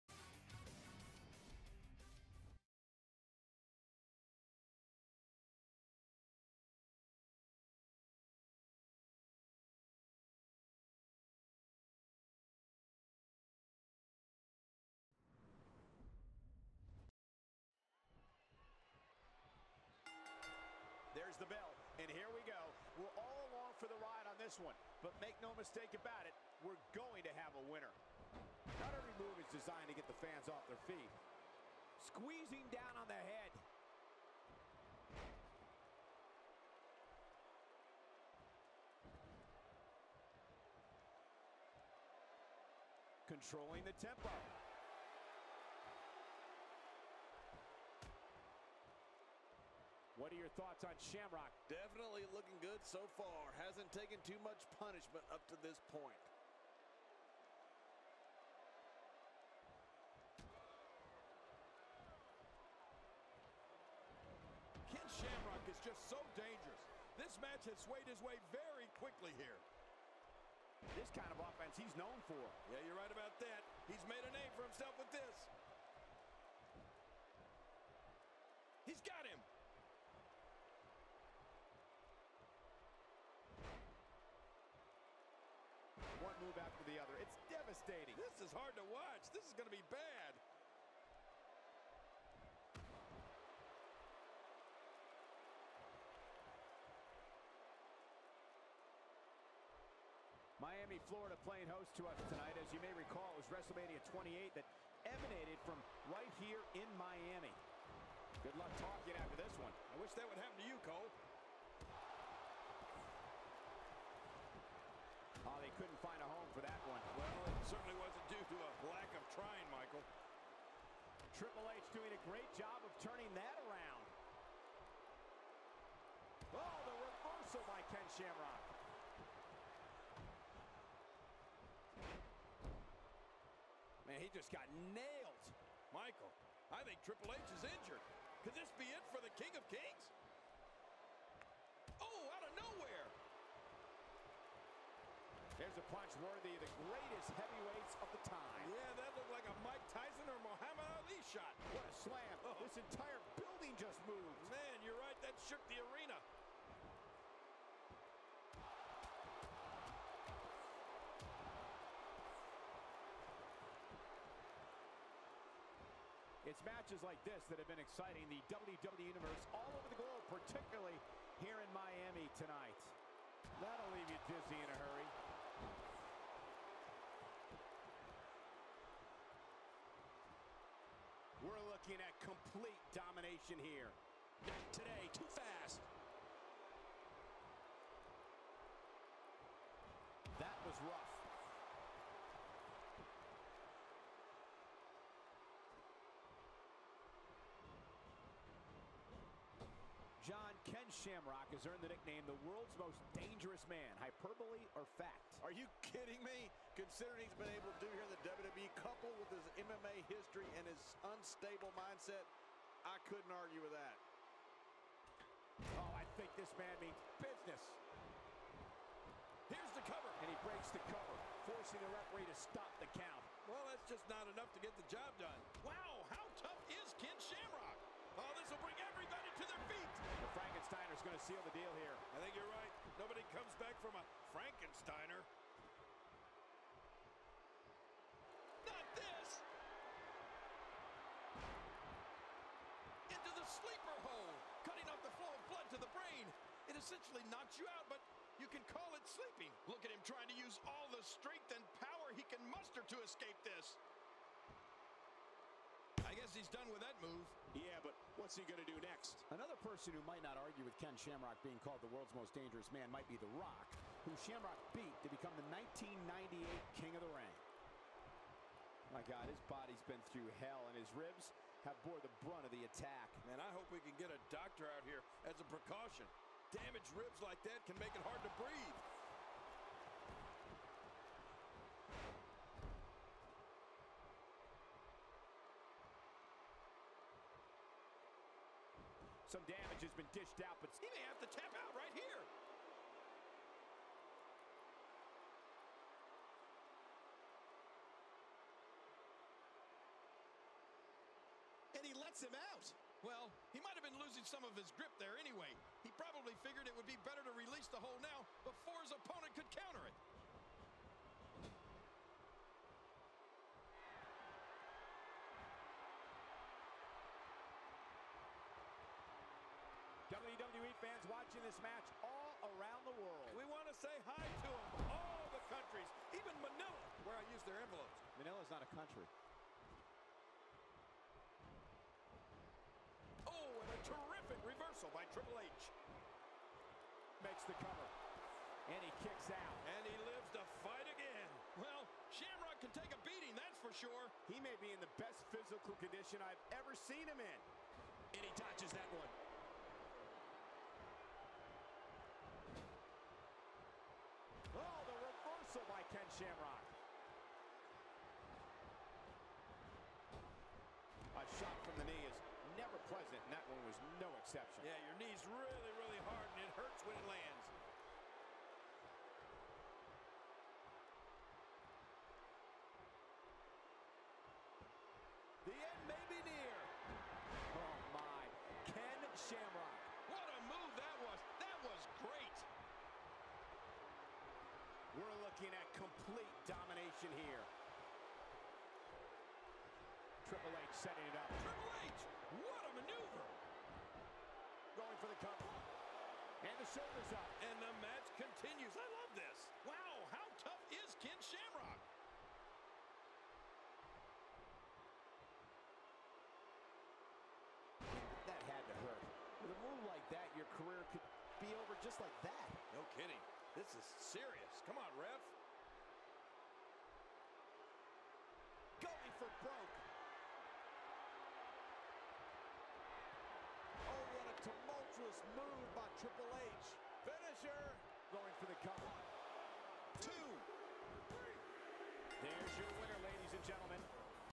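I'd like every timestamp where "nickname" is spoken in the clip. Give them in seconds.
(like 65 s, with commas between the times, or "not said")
201 s.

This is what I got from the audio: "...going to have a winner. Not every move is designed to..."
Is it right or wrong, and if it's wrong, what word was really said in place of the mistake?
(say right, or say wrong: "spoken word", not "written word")
right.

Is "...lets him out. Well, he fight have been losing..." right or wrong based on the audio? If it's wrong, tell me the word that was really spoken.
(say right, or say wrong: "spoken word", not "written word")
wrong: "might", not "fight".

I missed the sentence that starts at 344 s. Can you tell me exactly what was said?
He may be in the best physical condition I've ever seen him in.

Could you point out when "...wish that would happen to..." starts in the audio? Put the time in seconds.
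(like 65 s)
110 s.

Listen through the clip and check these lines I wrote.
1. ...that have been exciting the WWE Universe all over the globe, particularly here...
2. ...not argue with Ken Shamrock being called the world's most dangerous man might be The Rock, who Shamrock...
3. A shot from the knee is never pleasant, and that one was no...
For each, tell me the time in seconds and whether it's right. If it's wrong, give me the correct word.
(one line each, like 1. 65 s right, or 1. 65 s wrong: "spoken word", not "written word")
1. 167 s right
2. 260 s right
3. 361 s right.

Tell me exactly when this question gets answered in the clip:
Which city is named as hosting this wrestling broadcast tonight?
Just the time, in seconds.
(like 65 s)
100 s.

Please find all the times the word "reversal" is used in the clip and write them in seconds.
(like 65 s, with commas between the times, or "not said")
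126 s, 334 s.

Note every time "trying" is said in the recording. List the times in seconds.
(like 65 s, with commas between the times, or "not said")
119 s, 250 s.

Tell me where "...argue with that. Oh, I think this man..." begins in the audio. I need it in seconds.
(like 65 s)
213 s.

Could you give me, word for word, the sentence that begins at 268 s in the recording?
My God, his body's been through hell, and his ribs have bore the brunt of the attack.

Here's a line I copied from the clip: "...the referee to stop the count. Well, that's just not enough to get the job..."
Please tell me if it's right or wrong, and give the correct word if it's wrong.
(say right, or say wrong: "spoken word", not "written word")
right.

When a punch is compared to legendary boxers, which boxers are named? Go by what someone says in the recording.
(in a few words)
Mike Tyson or Muhammad Ali.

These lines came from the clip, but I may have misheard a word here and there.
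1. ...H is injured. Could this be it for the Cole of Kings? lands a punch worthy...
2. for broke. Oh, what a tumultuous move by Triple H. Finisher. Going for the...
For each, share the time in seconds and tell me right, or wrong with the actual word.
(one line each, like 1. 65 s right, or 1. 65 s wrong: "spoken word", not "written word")
1. 137 s wrong: "King", not "Cole"
2. 419 s right.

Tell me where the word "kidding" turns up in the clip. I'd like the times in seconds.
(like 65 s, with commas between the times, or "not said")
205 s, 412 s.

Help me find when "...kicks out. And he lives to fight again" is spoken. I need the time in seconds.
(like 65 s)
339 s.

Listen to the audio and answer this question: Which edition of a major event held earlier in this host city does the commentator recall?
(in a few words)
WrestleMania 28.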